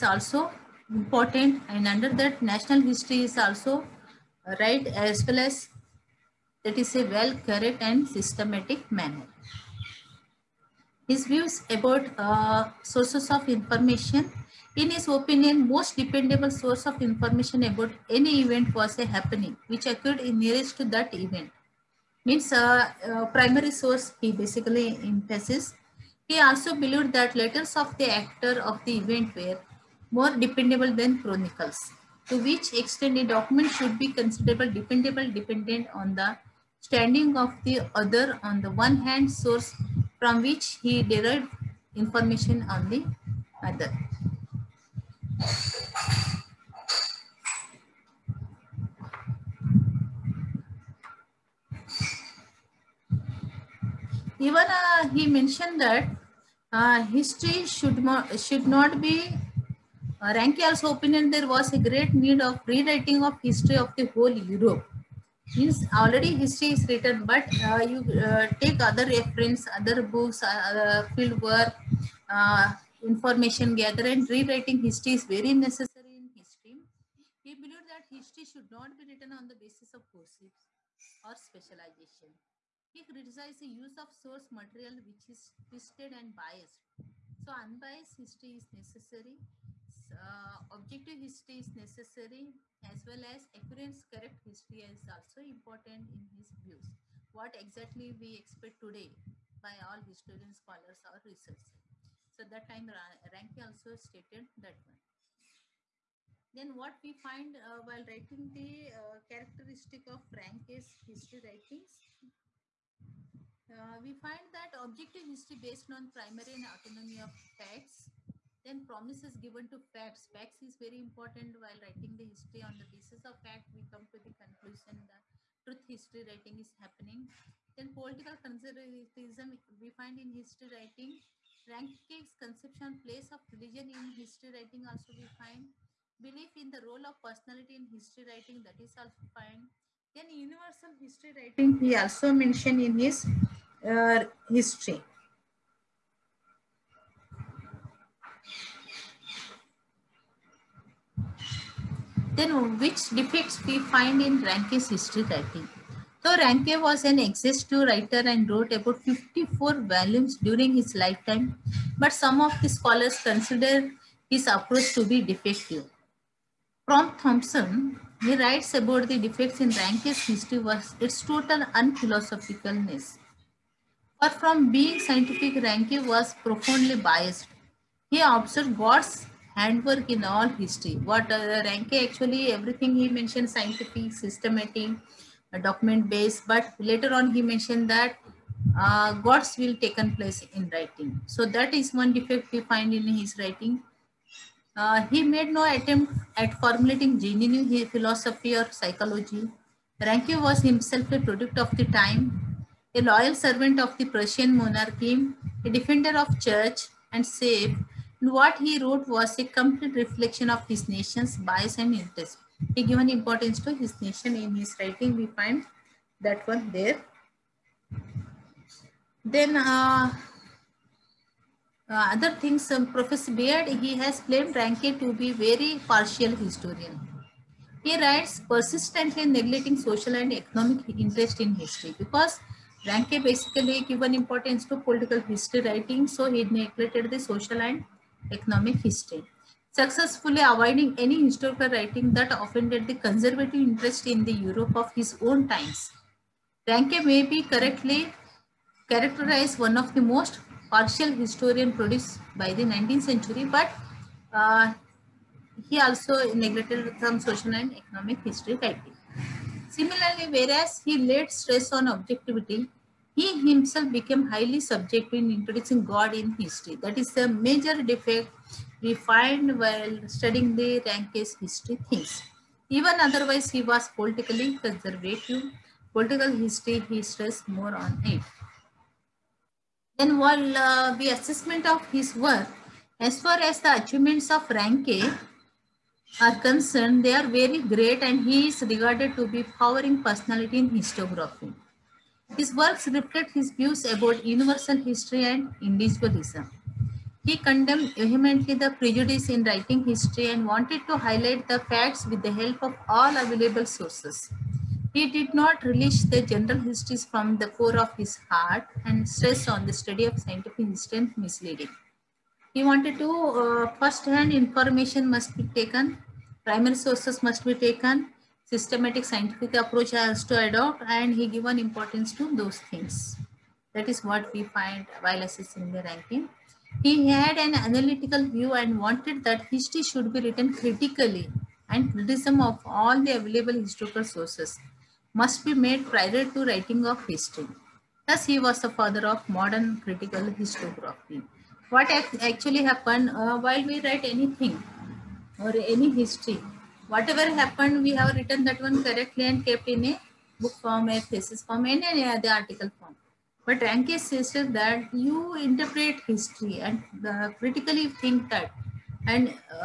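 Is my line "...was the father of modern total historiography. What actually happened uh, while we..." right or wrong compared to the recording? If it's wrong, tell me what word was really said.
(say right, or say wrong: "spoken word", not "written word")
wrong: "critical", not "total".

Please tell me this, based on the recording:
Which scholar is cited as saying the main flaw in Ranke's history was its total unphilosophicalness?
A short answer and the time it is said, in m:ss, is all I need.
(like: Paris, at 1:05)
Thompson, at 2:47.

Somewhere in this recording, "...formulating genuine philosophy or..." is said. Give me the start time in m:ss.
3:16.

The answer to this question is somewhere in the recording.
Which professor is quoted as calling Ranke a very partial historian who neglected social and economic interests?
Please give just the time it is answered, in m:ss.
3:42.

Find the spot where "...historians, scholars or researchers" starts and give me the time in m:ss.
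1:40.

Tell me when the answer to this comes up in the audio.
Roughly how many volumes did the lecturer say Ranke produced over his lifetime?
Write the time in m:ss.
2:39.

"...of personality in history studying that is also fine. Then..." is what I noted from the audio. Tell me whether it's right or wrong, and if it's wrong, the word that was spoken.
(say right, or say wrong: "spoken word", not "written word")
wrong: "writing", not "studying".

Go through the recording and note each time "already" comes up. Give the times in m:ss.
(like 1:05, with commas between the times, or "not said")
1:05.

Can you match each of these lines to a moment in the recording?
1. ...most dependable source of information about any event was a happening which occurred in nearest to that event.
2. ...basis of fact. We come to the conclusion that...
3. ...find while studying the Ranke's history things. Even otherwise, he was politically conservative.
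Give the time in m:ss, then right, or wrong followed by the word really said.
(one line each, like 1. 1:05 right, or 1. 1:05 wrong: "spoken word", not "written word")
1. 0:15 right
2. 2:02 right
3. 4:28 right.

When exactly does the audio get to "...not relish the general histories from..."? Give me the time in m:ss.
5:05.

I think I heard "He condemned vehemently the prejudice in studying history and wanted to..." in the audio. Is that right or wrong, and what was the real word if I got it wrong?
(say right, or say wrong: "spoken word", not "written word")
wrong: "writing", not "studying".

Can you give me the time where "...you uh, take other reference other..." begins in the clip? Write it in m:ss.
1:07.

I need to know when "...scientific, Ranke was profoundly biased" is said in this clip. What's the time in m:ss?
2:55.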